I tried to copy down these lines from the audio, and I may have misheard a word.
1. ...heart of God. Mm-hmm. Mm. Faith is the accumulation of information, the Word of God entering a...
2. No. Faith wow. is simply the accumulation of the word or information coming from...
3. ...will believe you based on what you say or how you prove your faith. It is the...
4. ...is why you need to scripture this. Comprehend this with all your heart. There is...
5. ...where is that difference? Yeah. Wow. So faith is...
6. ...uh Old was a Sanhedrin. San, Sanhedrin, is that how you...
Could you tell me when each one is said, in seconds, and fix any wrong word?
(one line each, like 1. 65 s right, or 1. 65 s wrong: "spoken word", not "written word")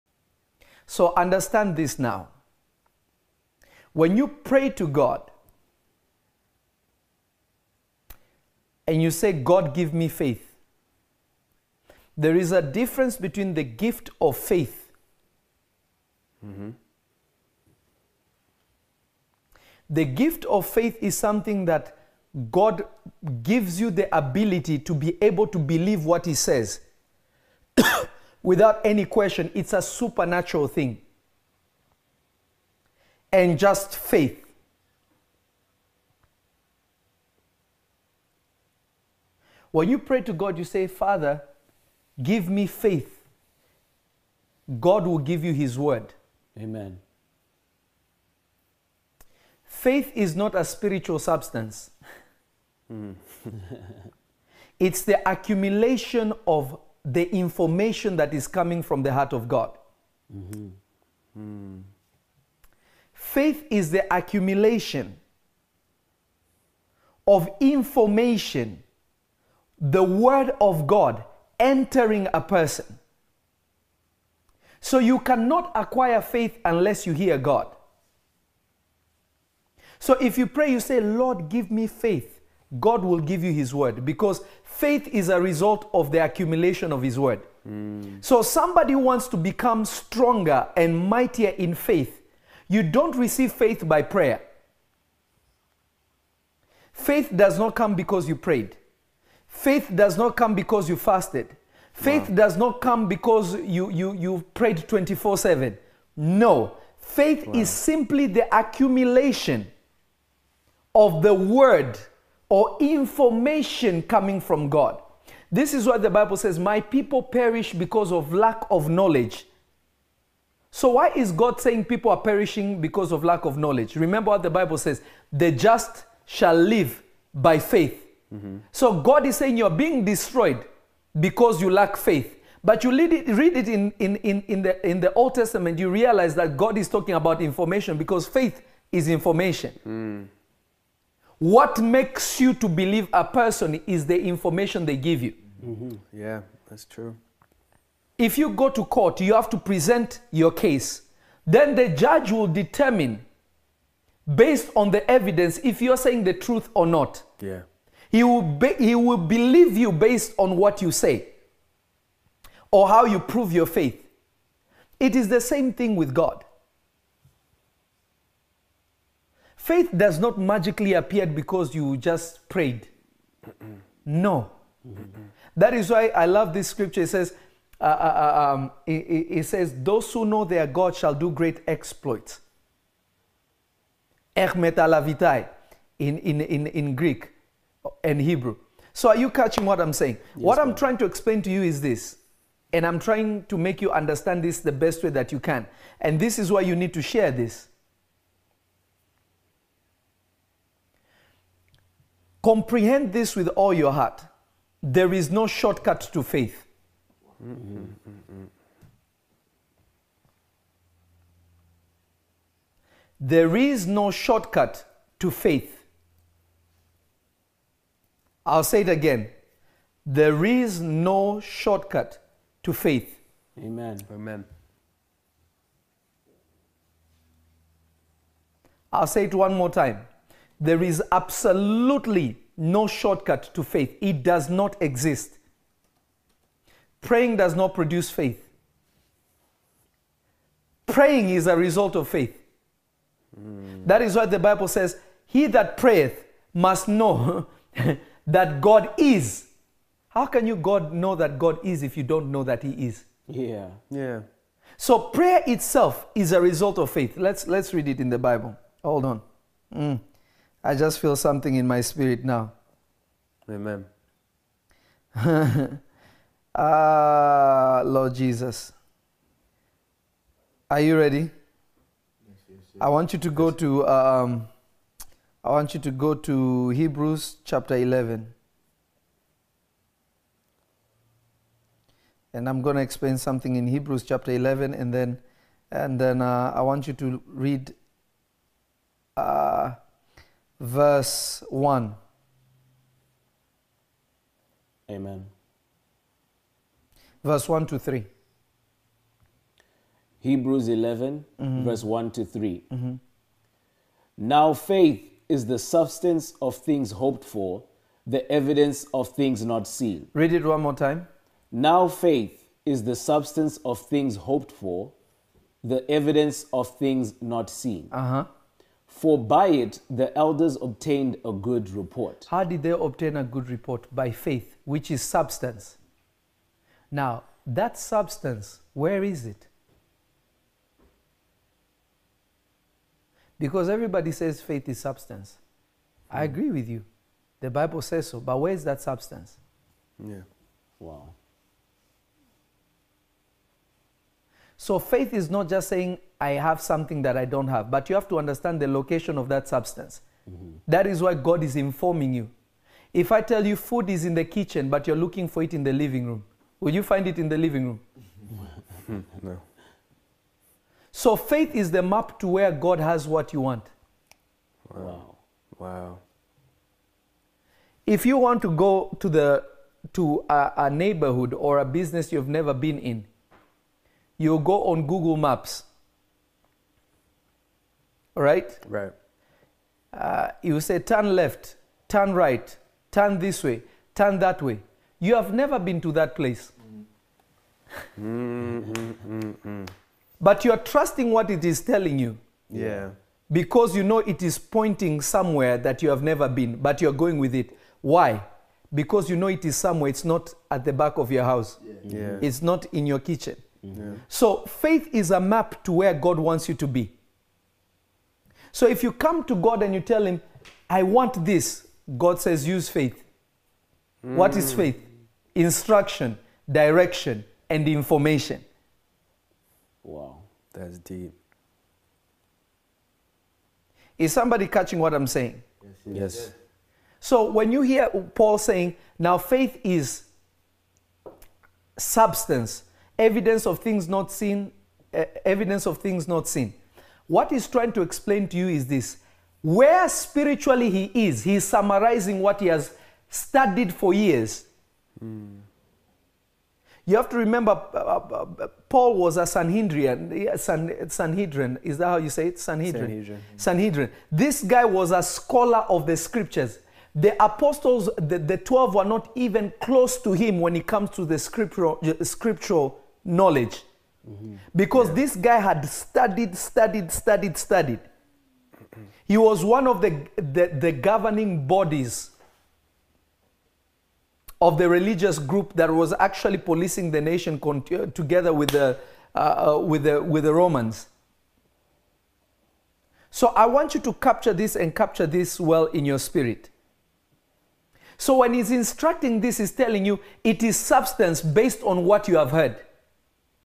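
1. 59 s right
2. 106 s right
3. 158 s right
4. 196 s wrong: "share", not "scripture"
5. 338 s wrong: "substance", not "difference"
6. 448 s wrong: "Paul", not "Old".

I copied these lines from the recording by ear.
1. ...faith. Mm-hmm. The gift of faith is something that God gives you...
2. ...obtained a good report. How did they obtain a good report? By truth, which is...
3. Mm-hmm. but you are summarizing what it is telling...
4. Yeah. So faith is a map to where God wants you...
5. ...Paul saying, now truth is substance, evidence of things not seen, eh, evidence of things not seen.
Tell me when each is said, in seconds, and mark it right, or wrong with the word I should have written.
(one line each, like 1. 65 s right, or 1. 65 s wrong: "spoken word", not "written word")
1. 14 s right
2. 320 s wrong: "faith", not "truth"
3. 387 s wrong: "trusting", not "summarizing"
4. 403 s right
5. 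427 s wrong: "faith", not "truth".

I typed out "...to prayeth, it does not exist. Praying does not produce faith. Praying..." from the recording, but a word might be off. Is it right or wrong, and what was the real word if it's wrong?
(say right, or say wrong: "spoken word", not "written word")
wrong: "faith", not "prayeth".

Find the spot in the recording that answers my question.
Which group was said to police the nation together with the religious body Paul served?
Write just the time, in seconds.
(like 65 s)
480 s.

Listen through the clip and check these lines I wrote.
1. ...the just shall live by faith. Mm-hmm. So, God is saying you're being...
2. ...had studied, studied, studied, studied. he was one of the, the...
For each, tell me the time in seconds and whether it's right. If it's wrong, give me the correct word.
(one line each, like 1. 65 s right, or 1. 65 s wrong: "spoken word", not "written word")
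1. 125 s right
2. 465 s right.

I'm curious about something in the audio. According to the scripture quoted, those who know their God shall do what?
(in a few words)
great exploits.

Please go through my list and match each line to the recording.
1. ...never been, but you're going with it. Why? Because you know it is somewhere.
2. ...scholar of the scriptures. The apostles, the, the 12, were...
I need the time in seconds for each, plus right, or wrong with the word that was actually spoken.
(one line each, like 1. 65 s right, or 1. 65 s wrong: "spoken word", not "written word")
1. 396 s right
2. 455 s right.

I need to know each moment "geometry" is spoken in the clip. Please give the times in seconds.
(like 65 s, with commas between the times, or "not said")
not said.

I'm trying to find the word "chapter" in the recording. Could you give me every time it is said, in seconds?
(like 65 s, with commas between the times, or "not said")
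277 s, 284 s.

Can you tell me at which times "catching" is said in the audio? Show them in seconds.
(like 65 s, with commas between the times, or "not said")
189 s, 424 s.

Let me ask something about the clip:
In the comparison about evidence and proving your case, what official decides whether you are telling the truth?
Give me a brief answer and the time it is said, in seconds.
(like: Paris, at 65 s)
the judge, at 151 s.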